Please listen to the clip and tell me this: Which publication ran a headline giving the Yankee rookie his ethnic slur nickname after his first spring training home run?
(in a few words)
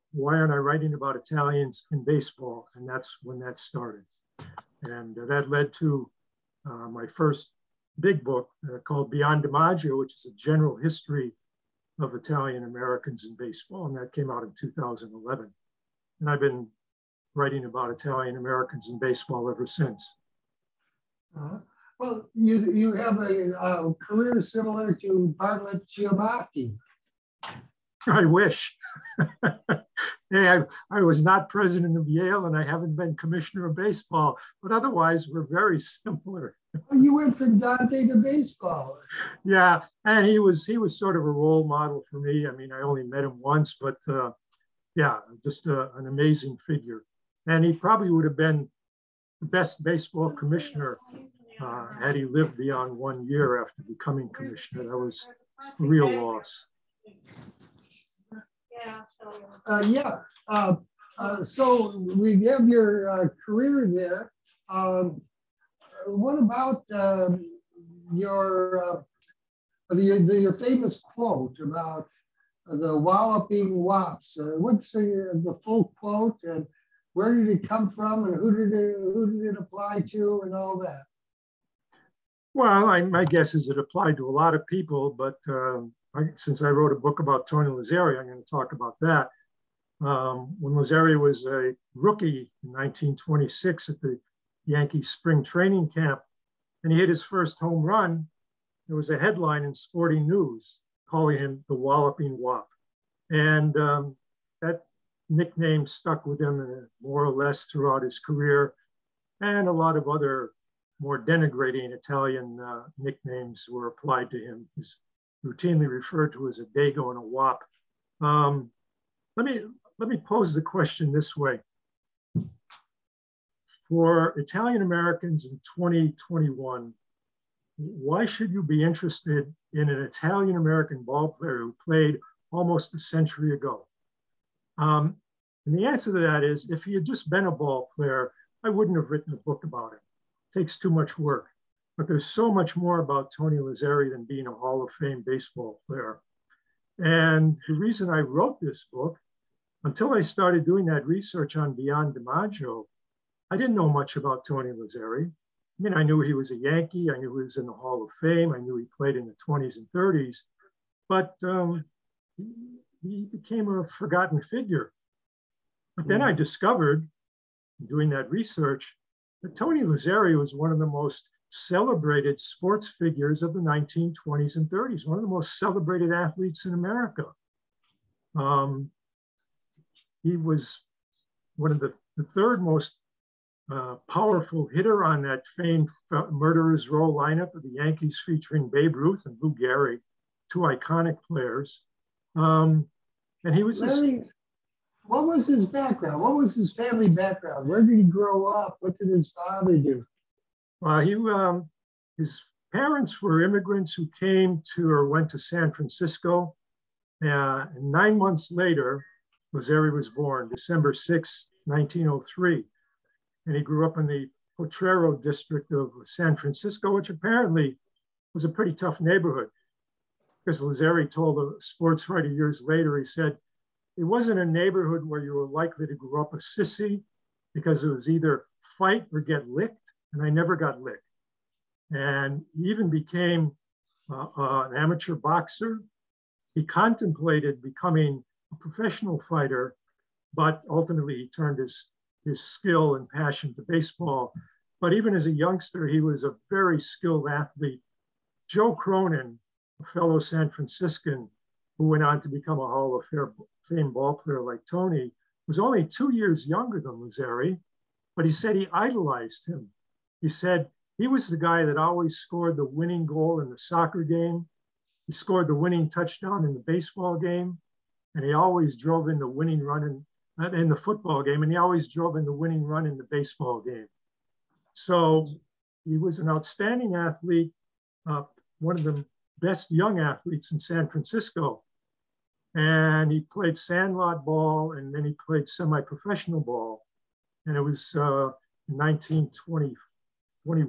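Sporting News.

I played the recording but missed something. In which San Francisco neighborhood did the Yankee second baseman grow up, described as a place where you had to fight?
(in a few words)
Potrero district.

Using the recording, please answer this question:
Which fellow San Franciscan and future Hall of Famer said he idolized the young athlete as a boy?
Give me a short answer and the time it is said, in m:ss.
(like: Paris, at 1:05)
Joe Cronin, at 4:08.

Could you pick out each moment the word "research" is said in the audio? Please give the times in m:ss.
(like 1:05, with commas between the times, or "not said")
2:31, 2:48.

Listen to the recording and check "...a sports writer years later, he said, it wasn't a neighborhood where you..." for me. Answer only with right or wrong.
right.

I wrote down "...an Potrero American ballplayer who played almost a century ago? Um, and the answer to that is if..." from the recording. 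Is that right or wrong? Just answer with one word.
wrong.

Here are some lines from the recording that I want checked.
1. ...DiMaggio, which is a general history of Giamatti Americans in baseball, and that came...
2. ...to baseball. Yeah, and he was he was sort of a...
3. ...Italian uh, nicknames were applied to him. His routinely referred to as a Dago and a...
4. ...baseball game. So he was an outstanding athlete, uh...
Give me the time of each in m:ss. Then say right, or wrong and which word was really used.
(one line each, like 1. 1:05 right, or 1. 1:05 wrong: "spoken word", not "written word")
1. 0:09 wrong: "Italian", not "Giamatti"
2. 0:38 right
3. 1:51 right
4. 4:33 right.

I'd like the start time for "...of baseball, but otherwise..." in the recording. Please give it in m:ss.
0:33.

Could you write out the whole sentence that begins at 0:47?
And he probably would have been the best baseball commissioner uh, had he lived beyond one year after becoming commissioner.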